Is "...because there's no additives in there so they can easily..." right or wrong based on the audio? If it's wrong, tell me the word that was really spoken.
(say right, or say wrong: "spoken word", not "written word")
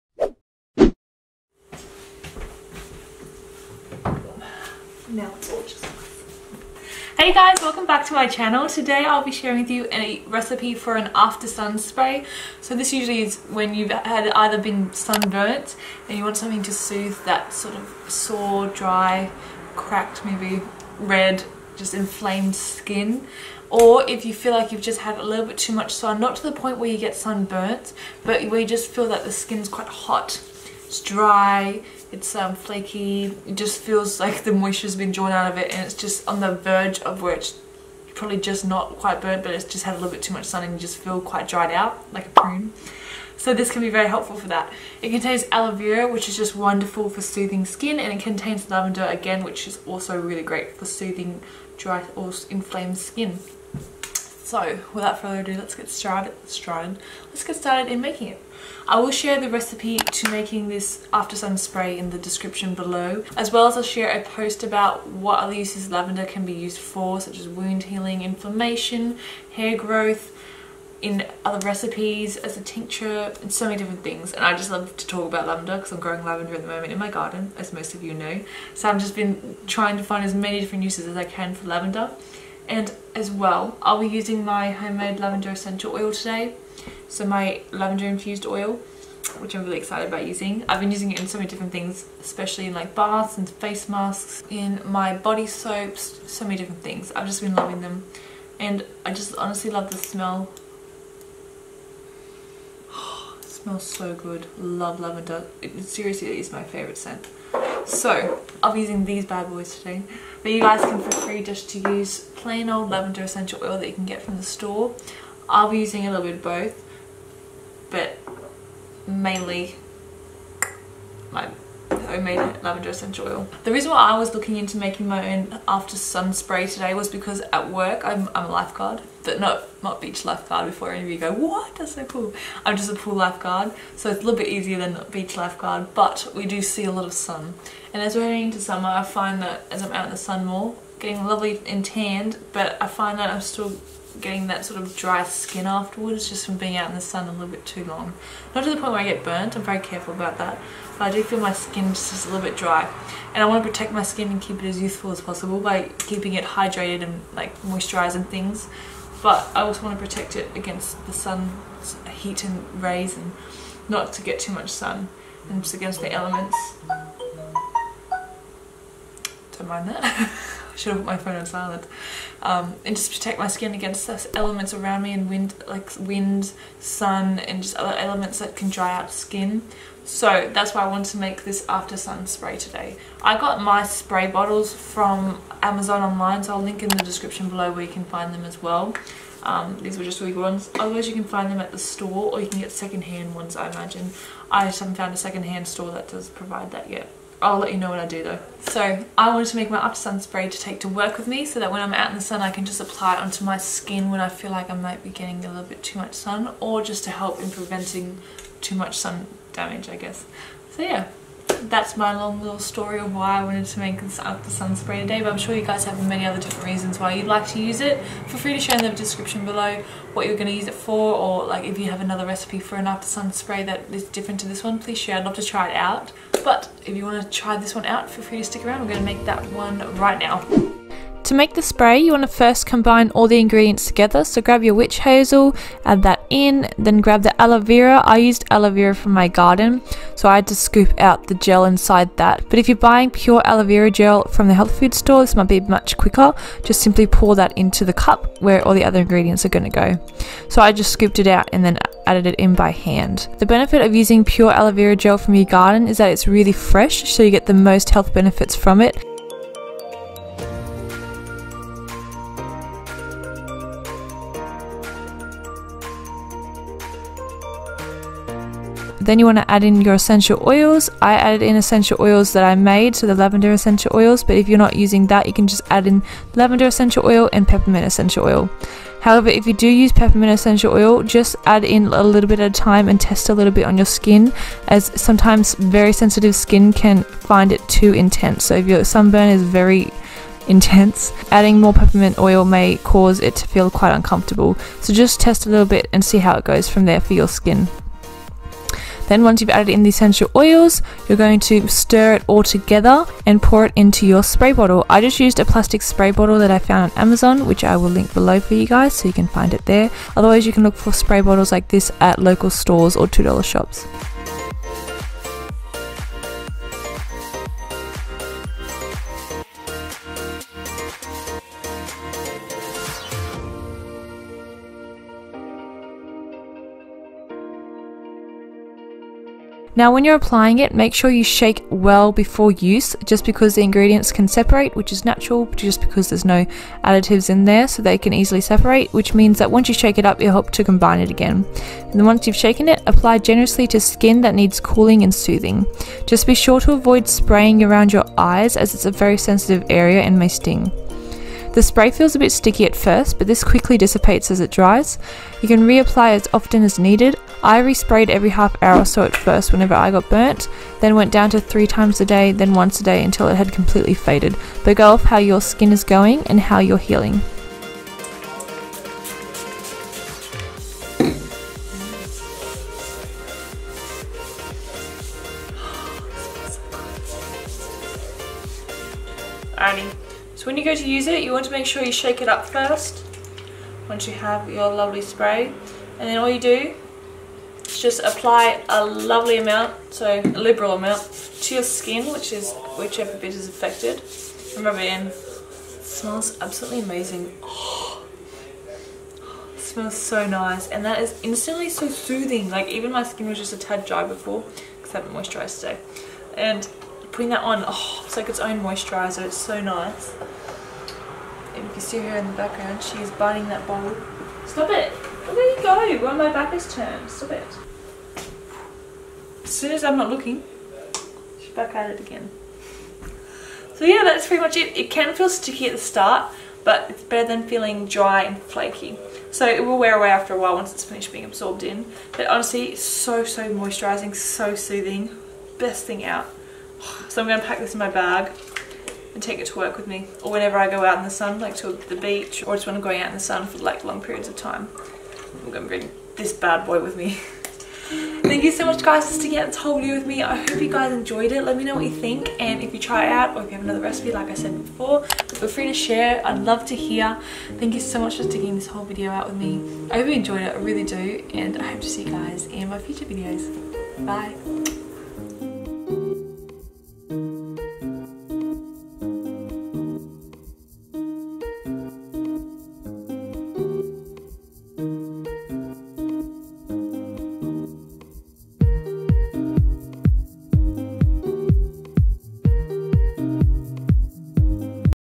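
right.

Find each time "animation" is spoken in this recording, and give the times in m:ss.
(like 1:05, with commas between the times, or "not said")
not said.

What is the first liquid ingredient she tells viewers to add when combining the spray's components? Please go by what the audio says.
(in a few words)
Witch hazel.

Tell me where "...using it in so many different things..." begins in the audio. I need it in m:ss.
1:30.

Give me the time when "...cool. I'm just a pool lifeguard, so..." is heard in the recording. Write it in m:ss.
2:12.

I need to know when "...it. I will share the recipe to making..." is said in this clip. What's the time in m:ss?
0:58.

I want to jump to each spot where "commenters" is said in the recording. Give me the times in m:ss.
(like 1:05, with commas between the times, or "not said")
not said.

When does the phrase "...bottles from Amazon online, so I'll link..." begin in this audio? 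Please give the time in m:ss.
3:04.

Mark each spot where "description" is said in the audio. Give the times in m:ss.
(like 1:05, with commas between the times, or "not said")
1:02, 3:07, 3:38.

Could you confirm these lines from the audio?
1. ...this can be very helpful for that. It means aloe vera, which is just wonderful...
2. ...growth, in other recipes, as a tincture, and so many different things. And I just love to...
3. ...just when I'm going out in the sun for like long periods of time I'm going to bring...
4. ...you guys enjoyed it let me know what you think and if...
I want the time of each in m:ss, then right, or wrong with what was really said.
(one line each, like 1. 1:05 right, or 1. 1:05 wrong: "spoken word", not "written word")
1. 0:43 wrong: "contains", not "means"
2. 1:09 right
3. 7:22 right
4. 7:30 right.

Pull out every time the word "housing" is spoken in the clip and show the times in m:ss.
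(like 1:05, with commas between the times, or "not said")
not said.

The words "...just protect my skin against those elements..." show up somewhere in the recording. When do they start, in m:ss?
2:52.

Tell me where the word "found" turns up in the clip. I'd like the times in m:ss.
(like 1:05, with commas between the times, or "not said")
3:14, 5:06.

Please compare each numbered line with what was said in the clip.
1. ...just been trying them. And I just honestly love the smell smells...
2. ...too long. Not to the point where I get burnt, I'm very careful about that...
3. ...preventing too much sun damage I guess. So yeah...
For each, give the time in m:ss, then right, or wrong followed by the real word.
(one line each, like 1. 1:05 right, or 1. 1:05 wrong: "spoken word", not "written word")
1. 1:37 wrong: "loving", not "trying"
2. 2:27 right
3. 3:27 right.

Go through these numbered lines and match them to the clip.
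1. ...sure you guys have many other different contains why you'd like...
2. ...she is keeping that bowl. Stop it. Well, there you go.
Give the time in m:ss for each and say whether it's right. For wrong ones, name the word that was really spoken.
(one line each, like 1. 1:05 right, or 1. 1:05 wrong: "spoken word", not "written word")
1. 3:35 wrong: "reasons", not "contains"
2. 6:52 wrong: "biting", not "keeping".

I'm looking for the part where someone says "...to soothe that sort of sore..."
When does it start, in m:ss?
0:16.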